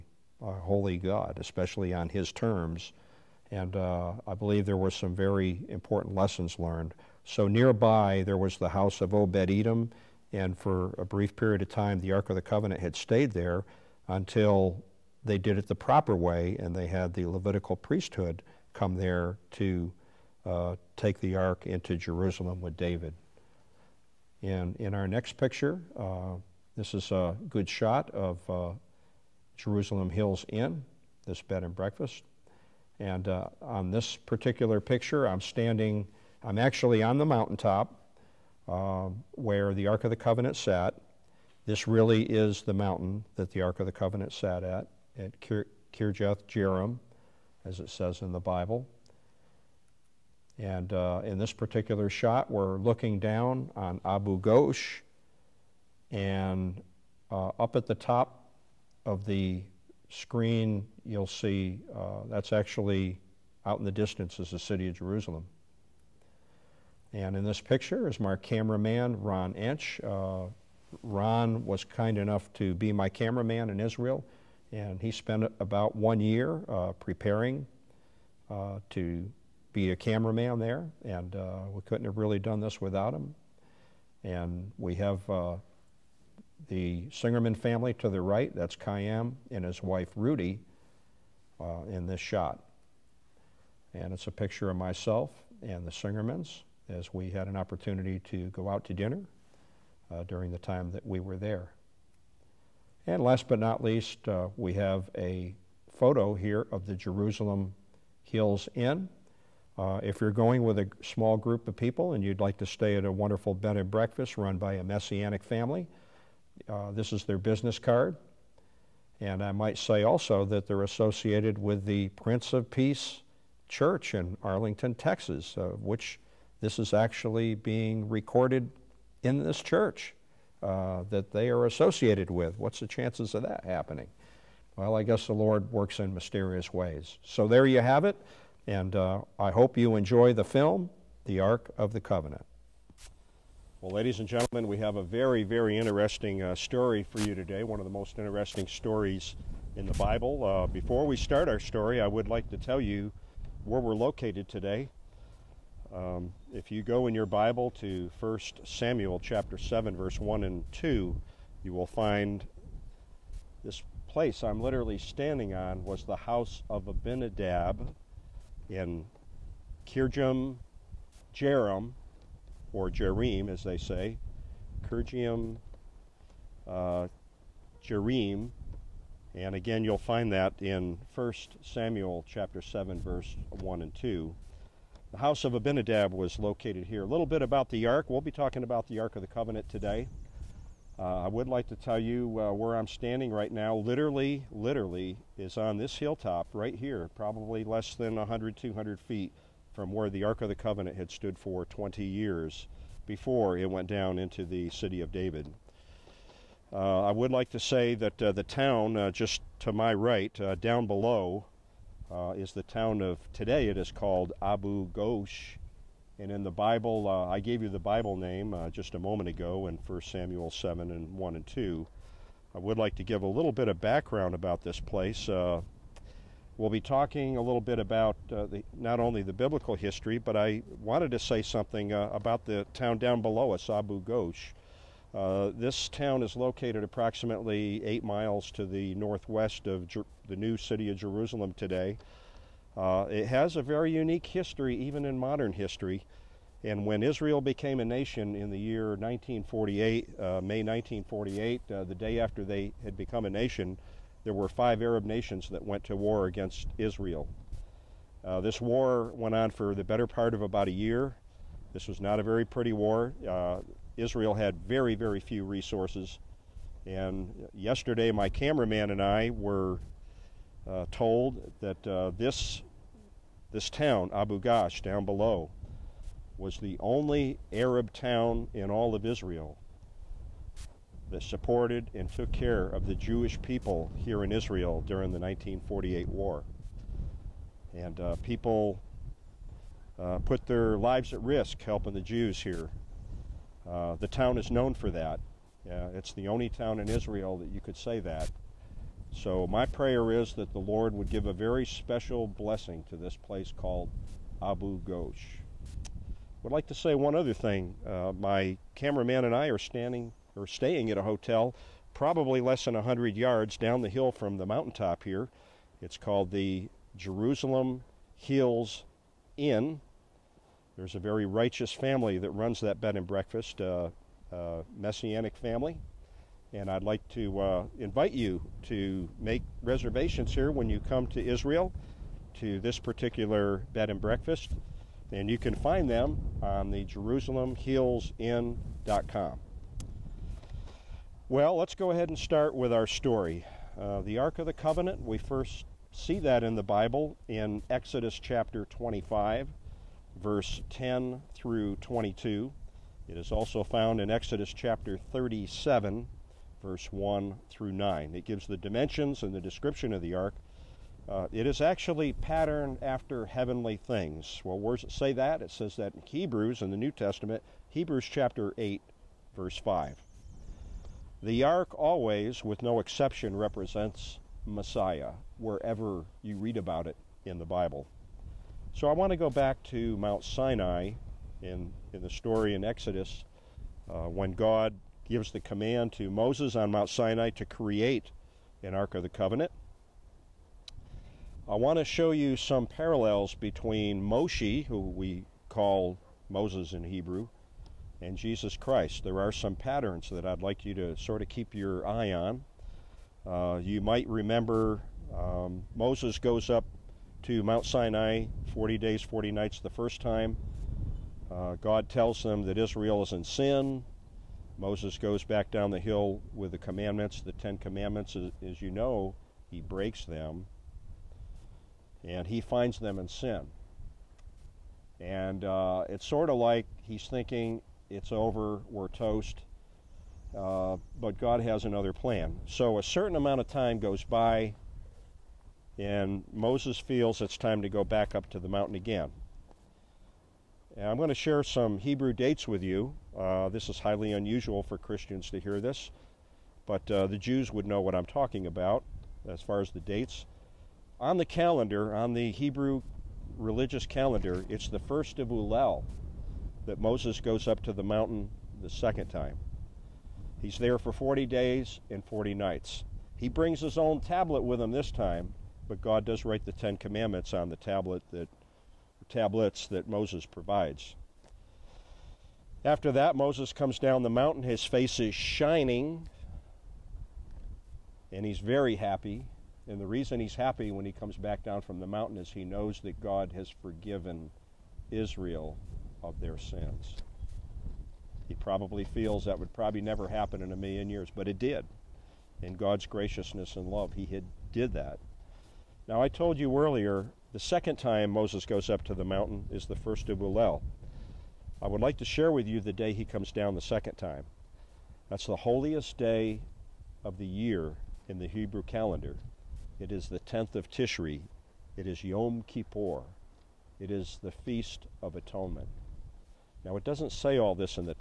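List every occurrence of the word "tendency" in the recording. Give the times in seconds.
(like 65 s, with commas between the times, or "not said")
not said.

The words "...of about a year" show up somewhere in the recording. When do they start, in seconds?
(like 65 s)
260 s.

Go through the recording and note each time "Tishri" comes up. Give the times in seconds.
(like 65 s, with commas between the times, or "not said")
510 s.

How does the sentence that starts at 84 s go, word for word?
And we have uh, the Singerman family to the right, that's Chaim and his wife Ruti uh, in this shot.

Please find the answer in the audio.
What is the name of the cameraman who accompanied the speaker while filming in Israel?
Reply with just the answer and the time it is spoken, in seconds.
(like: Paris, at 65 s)
Ron Inch, at 69 s.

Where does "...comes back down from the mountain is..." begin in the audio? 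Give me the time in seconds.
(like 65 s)
480 s.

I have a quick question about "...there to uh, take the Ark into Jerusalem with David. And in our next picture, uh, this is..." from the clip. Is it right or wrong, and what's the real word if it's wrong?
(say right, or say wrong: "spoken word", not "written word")
right.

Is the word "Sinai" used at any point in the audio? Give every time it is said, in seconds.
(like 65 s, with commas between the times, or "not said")
380 s, 386 s, 407 s.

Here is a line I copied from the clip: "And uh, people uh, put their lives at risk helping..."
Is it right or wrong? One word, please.
right.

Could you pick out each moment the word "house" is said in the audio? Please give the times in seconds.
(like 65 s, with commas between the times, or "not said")
8 s, 166 s, 185 s.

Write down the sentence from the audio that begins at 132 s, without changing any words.
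What's the chances of that happening?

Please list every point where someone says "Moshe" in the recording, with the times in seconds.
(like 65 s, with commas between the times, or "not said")
394 s.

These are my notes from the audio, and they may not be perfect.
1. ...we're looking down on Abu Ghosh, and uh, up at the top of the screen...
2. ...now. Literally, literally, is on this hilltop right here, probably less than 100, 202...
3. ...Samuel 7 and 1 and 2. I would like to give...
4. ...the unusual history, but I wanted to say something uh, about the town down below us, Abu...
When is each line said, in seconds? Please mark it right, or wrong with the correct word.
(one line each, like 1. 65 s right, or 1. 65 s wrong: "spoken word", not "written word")
1. 52 s right
2. 193 s wrong: "200", not "202"
3. 220 s right
4. 229 s wrong: "biblical", not "unusual".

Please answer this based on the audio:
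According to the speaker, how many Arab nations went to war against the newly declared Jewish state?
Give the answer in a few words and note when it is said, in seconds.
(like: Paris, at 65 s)
5, at 254 s.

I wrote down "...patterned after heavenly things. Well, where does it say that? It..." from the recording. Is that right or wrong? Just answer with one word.
right.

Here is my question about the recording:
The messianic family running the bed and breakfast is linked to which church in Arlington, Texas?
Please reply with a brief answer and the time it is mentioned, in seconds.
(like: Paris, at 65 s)
Prince of Peace Church, at 122 s.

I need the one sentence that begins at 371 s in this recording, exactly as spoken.
The ark always, with no exception, represents Messiah wherever you read about it in the Bible.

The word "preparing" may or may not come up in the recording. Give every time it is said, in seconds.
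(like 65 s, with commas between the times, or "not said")
76 s.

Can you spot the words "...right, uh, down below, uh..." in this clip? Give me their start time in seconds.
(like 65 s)
209 s.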